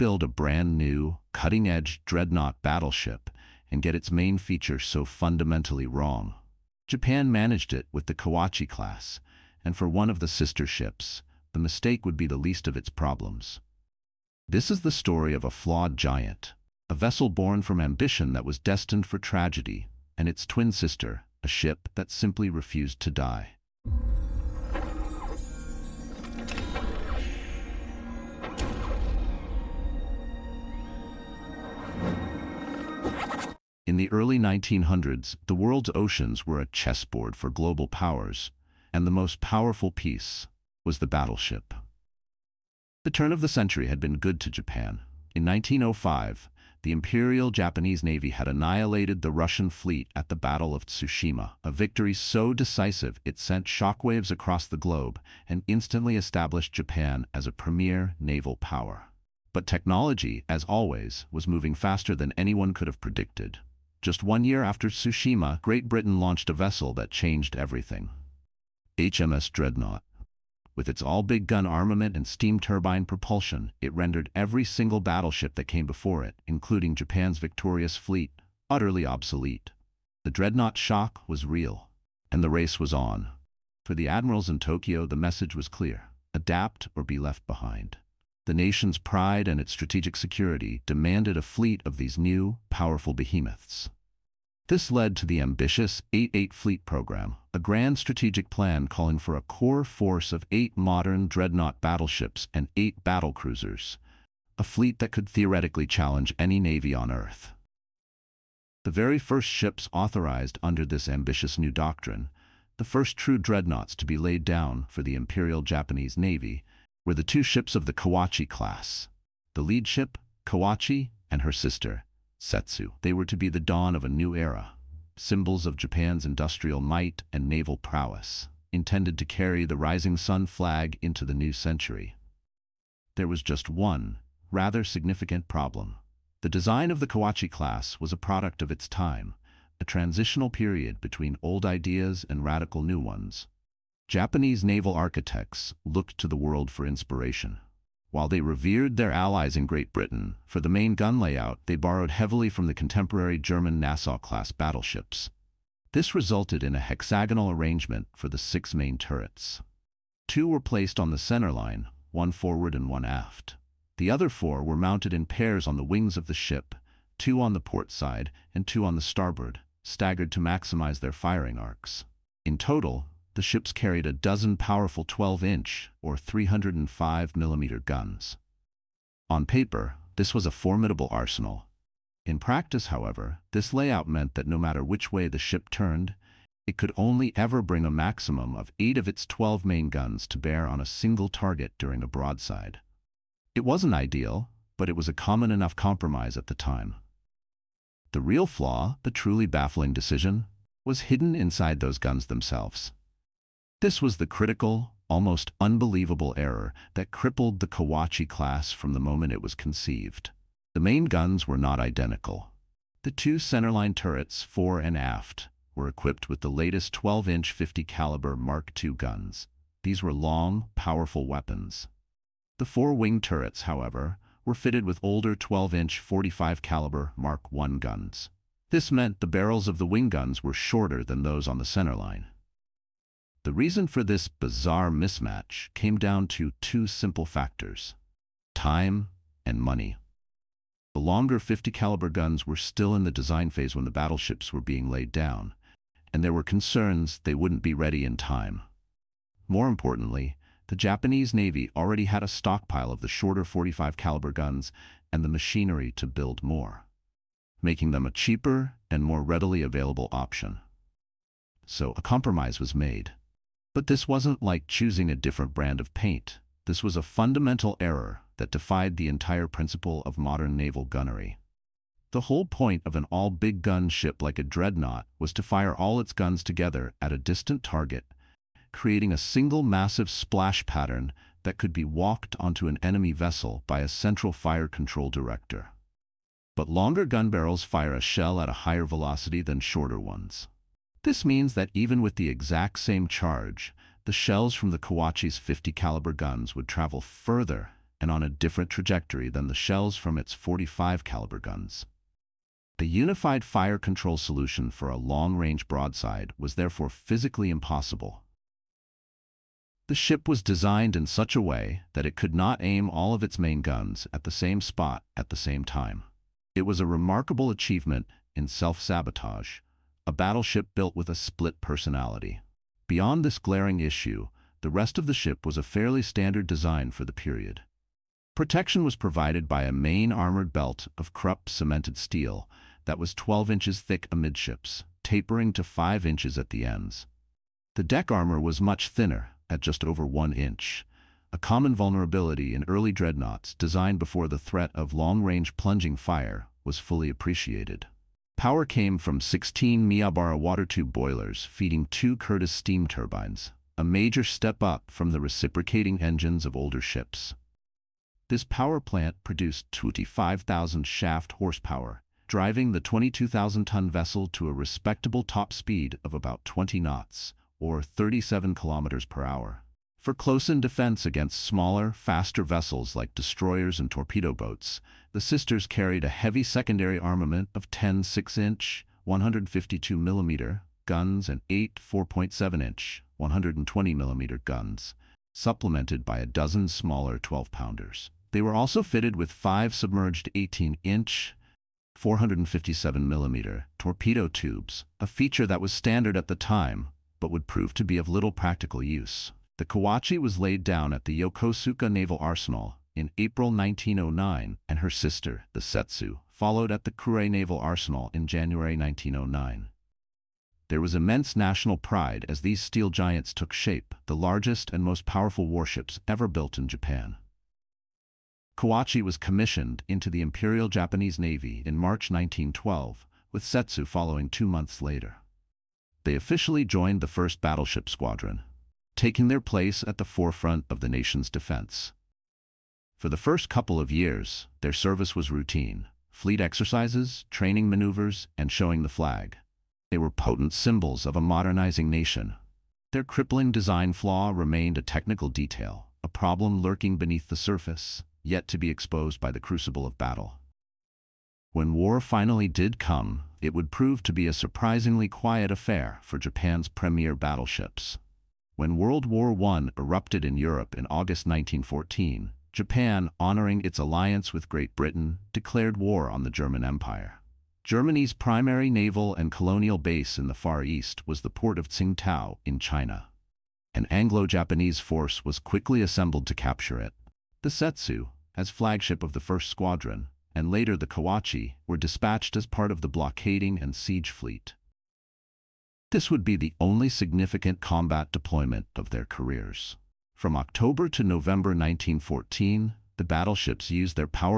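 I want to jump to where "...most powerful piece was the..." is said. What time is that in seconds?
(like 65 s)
39 s.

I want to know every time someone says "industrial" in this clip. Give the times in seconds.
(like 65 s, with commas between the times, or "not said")
126 s.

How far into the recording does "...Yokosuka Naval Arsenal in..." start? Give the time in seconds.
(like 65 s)
401 s.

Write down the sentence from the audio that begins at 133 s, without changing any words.
There was just one, rather significant problem.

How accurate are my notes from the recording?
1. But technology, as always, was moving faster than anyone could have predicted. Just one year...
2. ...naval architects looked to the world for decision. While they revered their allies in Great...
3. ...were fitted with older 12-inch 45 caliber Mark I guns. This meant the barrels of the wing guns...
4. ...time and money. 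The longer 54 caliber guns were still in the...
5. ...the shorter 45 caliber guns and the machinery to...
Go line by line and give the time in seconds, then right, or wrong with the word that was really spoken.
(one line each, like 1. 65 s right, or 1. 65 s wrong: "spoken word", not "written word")
1. 59 s right
2. 144 s wrong: "inspiration", not "decision"
3. 224 s right
4. 238 s wrong: "50", not "54"
5. 253 s right.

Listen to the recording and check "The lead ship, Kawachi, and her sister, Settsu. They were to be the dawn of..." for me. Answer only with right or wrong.
right.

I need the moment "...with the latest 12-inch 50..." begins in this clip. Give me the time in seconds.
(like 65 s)
216 s.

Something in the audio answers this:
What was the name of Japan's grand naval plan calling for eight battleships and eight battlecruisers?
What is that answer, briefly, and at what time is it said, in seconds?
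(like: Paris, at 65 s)
8-8 Fleet Program, at 96 s.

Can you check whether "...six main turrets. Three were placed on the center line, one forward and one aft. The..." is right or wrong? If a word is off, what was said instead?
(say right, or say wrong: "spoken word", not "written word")
wrong: "Two", not "Three".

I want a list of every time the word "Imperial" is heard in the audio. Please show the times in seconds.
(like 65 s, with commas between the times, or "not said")
46 s, 115 s, 420 s.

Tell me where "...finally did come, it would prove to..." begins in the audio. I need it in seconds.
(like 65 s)
451 s.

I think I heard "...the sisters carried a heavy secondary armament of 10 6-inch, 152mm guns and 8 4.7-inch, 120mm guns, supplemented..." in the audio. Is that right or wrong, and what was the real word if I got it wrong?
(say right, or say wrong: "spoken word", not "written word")
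right.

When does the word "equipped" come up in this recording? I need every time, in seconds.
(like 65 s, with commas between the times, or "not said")
215 s.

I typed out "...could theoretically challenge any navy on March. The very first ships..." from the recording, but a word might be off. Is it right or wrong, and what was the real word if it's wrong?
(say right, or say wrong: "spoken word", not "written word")
wrong: "Earth", not "March".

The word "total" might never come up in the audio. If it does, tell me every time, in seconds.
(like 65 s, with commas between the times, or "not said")
172 s.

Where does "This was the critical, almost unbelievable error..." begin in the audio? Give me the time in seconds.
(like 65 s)
203 s.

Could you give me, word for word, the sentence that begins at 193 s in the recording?
It wasn't ideal, but it was a common enough compromise at the time.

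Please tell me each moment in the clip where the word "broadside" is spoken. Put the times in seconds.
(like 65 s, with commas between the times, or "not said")
192 s, 305 s.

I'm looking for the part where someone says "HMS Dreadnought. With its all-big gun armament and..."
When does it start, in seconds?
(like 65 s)
68 s.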